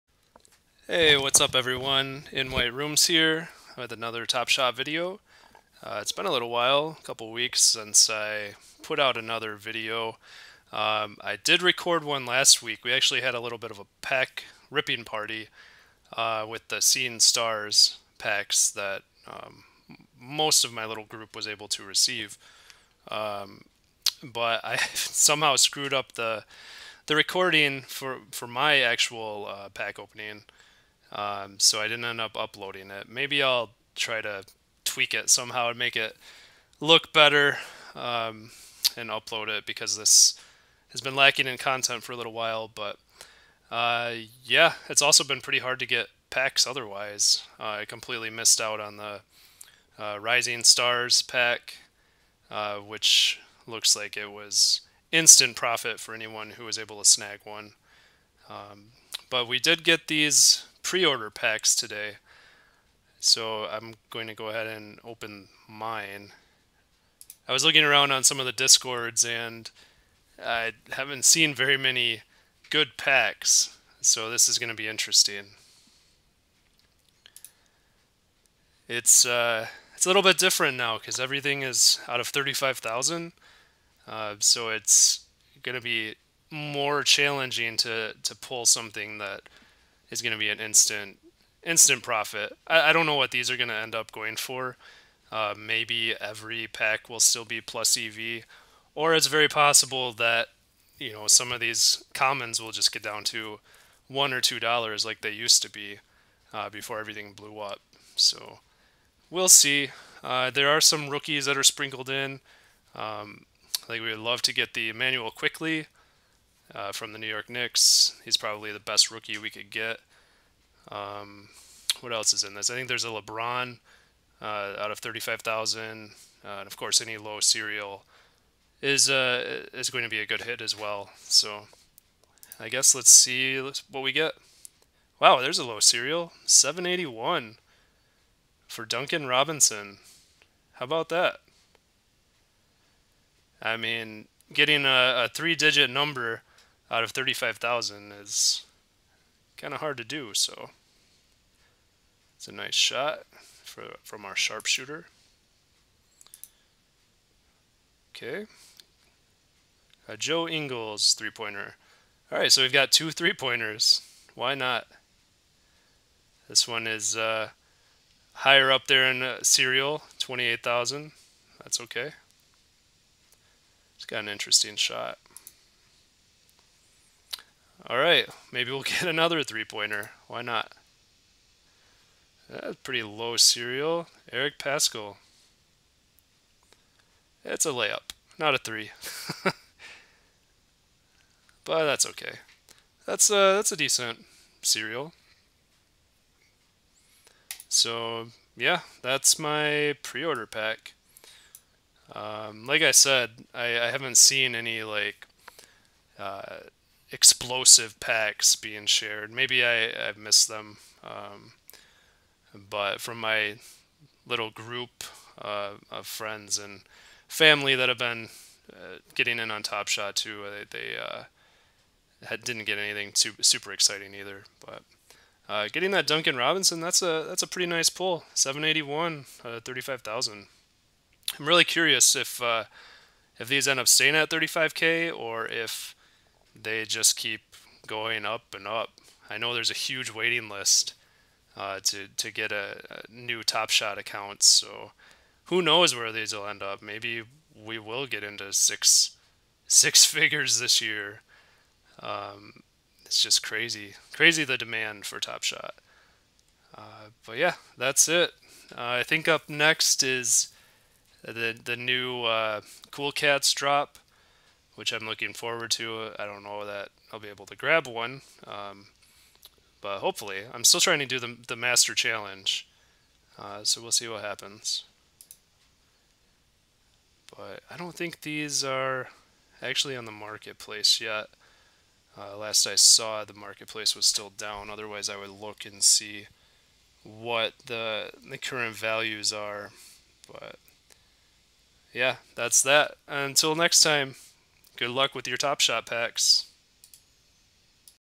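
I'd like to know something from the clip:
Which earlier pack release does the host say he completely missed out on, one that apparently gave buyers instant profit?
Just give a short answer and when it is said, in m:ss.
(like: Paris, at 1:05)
Rising Stars, at 0:50.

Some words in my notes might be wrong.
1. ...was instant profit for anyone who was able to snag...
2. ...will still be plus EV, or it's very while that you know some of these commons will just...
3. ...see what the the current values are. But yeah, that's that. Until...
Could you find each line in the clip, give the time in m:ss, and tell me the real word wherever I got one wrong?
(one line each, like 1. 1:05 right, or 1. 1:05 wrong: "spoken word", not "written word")
1. 0:54 right
2. 1:37 wrong: "possible", not "while"
3. 4:45 right.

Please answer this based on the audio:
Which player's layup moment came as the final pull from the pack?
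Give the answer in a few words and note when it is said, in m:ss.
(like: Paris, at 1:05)
Eric Paschall, at 3:04.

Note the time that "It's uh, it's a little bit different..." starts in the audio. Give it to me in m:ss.
1:18.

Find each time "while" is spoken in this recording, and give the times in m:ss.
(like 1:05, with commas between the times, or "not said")
0:06, 0:42.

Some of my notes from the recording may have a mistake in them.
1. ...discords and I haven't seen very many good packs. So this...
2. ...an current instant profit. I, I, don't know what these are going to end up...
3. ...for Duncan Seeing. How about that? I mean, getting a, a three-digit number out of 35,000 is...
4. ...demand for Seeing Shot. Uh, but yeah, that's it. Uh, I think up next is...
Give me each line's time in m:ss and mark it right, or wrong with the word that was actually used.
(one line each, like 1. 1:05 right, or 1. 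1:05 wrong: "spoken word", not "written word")
1. 1:08 right
2. 1:30 wrong: "instant", not "current"
3. 2:18 wrong: "Robinson", not "Seeing"
4. 4:14 wrong: "Top", not "Seeing".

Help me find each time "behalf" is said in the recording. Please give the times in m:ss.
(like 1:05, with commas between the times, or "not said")
not said.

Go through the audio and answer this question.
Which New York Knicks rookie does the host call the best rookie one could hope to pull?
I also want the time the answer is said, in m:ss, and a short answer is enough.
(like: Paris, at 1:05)
Immanuel Quickley, at 1:54.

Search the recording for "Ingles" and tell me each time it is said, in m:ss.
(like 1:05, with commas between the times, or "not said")
2:40.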